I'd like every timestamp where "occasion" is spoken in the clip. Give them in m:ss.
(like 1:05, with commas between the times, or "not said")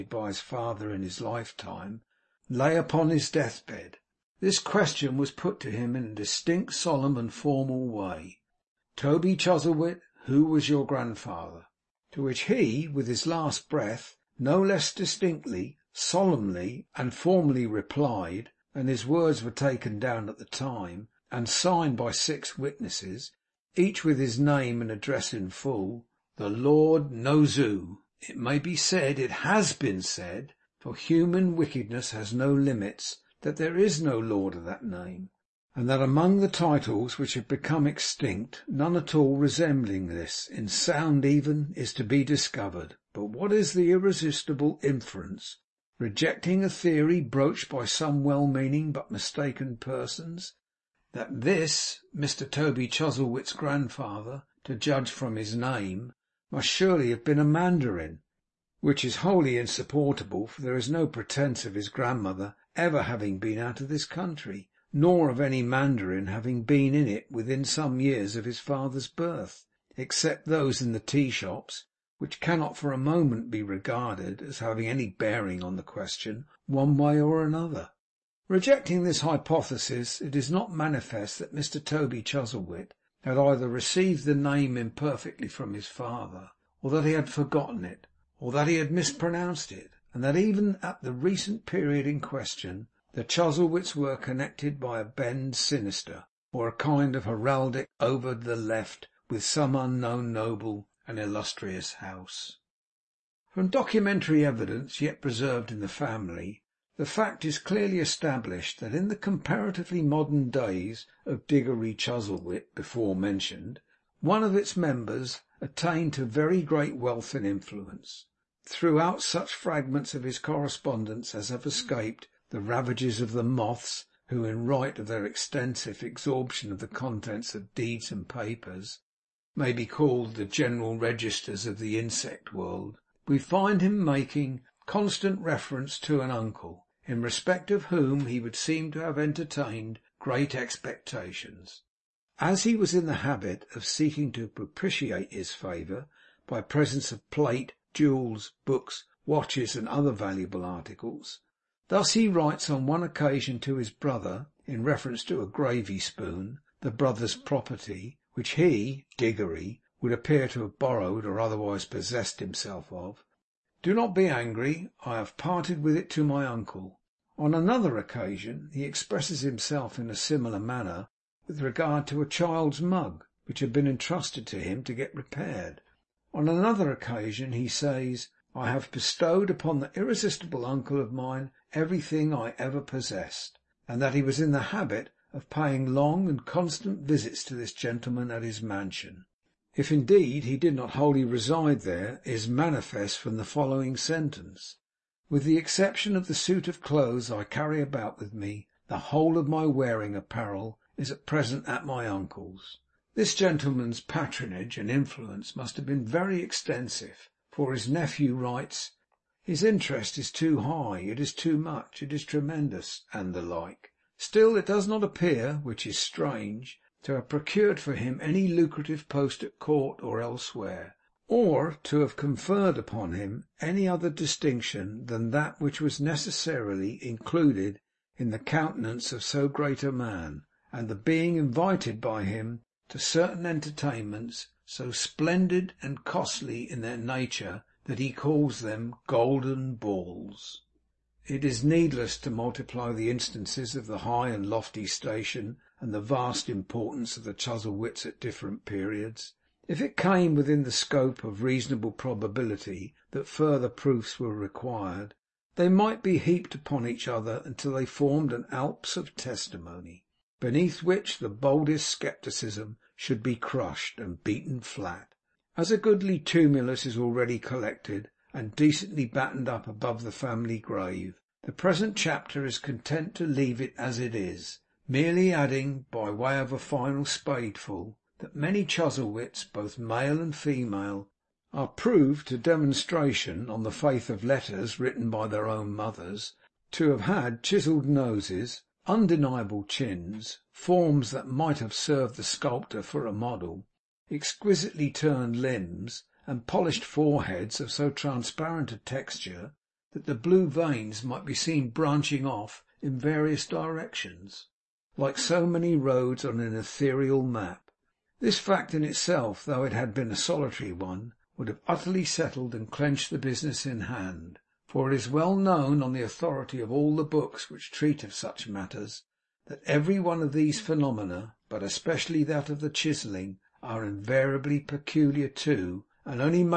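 2:47, 2:56.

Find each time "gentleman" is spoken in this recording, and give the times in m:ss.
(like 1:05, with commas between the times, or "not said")
3:07, 3:23.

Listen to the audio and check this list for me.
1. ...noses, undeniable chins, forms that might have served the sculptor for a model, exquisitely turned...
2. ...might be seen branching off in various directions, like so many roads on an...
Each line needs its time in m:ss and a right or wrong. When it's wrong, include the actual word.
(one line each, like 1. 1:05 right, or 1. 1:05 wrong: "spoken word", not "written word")
1. 4:47 right
2. 5:01 right.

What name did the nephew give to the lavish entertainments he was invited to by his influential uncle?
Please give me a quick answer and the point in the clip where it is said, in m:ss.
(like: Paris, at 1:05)
golden balls, at 3:59.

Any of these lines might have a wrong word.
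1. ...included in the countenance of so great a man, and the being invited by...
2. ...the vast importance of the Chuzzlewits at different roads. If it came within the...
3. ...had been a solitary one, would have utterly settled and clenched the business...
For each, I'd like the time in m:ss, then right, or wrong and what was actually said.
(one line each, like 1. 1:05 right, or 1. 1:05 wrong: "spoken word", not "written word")
1. 3:47 right
2. 4:05 wrong: "periods", not "roads"
3. 5:09 right.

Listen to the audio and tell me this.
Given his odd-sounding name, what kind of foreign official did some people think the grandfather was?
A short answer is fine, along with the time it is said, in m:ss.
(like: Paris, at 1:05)
a mandarin, at 0:57.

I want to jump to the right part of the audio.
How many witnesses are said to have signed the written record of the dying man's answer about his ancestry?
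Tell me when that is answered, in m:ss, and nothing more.
0:22.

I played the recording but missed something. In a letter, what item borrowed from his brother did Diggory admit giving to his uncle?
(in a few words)
a gravy spoon.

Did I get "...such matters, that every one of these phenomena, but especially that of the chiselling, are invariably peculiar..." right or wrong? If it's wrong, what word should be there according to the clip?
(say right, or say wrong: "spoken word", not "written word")
right.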